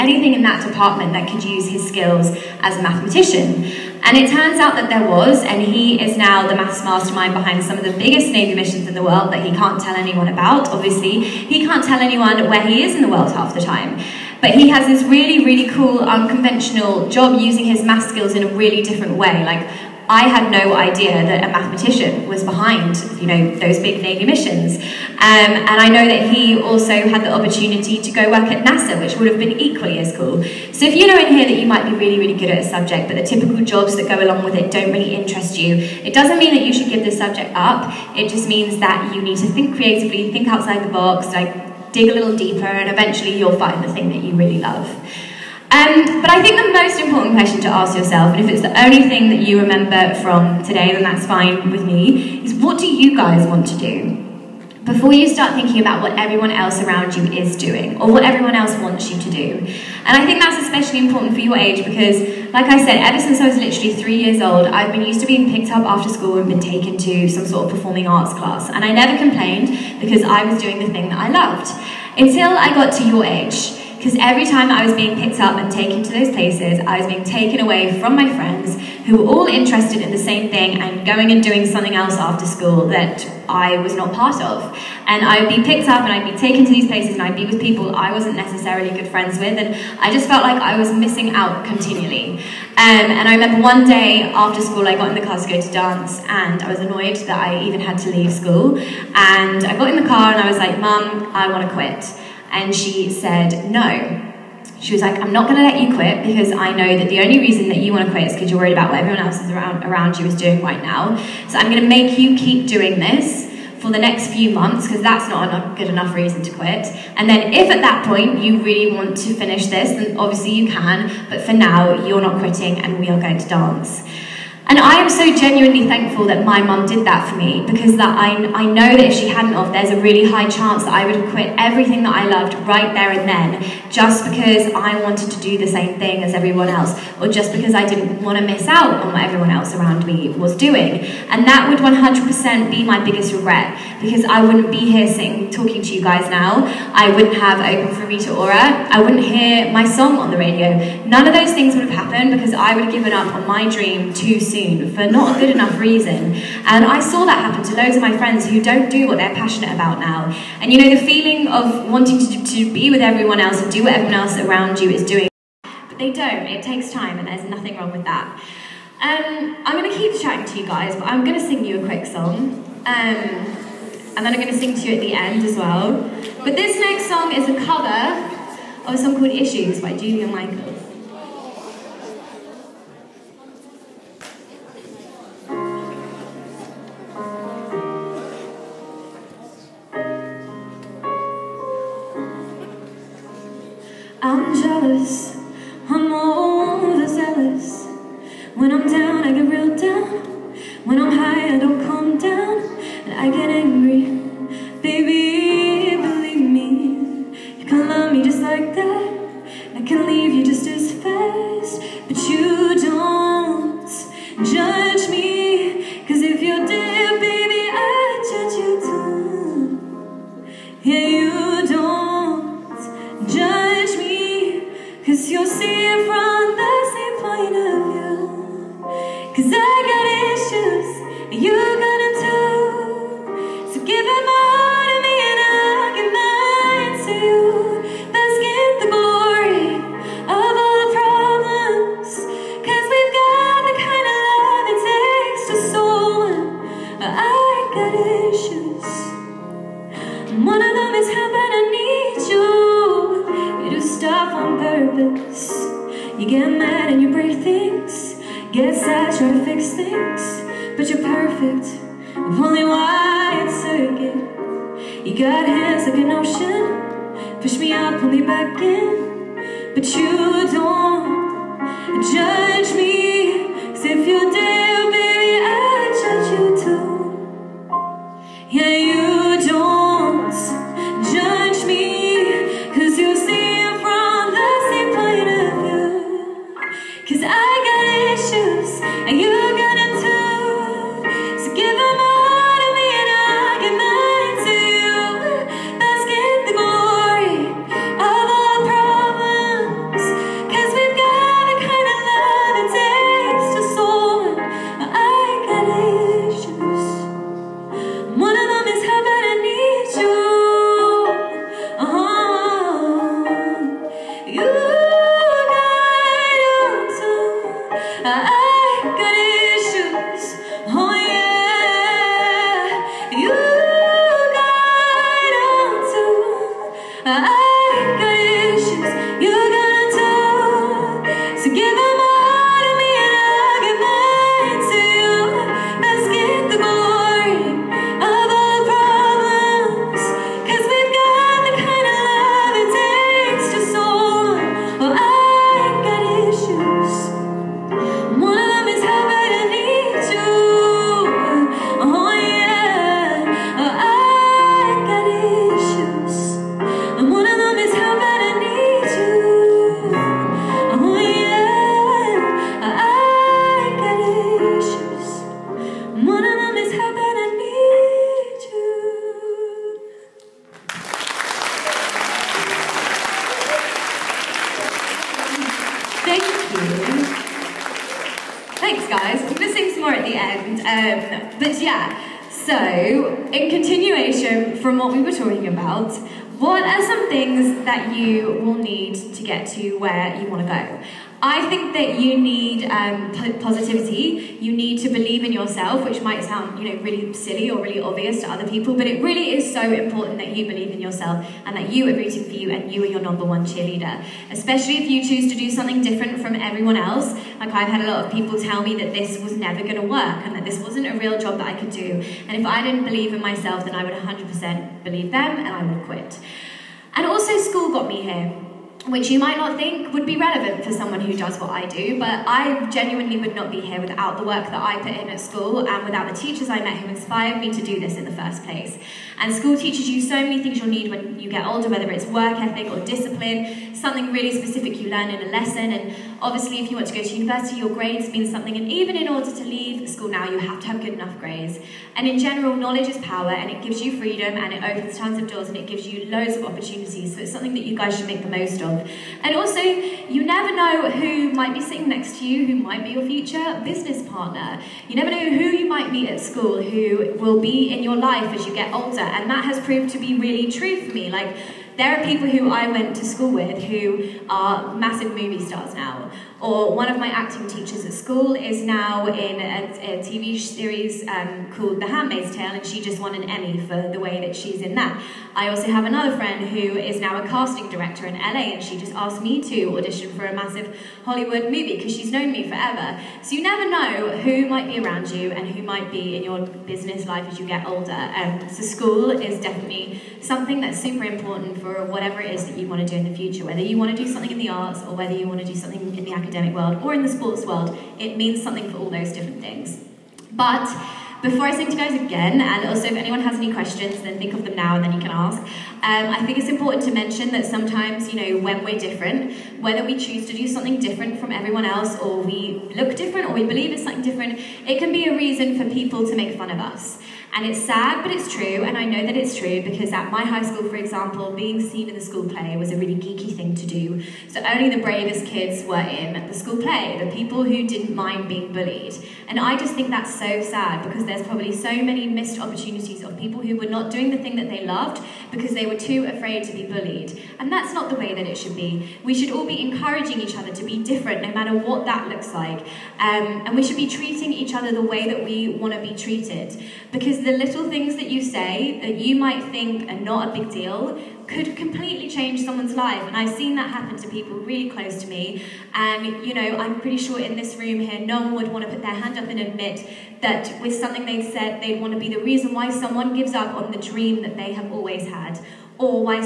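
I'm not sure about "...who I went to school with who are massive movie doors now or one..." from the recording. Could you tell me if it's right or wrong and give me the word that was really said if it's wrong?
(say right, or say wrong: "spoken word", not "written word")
wrong: "stars", not "doors".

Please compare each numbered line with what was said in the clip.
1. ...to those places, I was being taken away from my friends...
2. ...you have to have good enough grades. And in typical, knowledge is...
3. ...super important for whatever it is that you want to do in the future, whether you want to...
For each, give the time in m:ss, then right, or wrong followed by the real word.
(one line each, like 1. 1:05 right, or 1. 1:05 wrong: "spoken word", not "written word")
1. 1:16 right
2. 7:20 wrong: "general", not "typical"
3. 8:10 right.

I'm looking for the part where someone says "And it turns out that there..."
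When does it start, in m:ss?
0:04.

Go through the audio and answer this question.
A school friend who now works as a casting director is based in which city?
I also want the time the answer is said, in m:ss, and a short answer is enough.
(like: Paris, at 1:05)
LA, at 7:58.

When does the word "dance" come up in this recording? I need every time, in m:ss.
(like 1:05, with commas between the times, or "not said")
1:35, 2:03.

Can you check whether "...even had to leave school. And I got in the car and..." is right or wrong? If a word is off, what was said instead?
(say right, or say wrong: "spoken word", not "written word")
right.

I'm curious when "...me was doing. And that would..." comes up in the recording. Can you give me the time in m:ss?
2:20.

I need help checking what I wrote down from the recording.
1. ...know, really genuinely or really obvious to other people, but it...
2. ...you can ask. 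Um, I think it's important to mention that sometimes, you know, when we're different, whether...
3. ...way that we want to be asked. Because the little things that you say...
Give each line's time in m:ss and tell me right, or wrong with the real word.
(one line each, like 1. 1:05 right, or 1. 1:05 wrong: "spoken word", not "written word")
1. 6:36 wrong: "silly", not "genuinely"
2. 8:24 right
3. 9:04 wrong: "treated", not "asked".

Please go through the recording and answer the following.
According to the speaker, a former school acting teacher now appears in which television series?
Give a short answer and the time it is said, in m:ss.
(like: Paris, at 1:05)
The Handmaid's Tale, at 7:51.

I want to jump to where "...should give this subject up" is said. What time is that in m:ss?
0:36.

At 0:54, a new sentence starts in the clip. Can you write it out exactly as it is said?
Before you start thinking about what everyone else around you is doing, or what everyone else wants you to do.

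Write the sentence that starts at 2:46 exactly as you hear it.
It takes time, and there's nothing wrong with that.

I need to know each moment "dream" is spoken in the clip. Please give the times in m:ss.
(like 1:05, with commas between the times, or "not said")
2:33, 9:23.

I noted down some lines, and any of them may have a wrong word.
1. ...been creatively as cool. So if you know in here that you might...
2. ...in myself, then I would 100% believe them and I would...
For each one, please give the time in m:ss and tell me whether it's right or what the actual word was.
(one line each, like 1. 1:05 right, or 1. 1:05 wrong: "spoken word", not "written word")
1. 0:29 wrong: "equally", not "creatively"
2. 6:53 right.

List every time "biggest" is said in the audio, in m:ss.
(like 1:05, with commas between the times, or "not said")
0:07, 2:23.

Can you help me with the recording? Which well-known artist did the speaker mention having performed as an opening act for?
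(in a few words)
Rita Ora.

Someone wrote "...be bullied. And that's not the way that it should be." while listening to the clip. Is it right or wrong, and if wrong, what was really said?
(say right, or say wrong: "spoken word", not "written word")
right.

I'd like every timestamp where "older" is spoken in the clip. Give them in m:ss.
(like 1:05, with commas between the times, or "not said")
7:11, 7:38, 8:07.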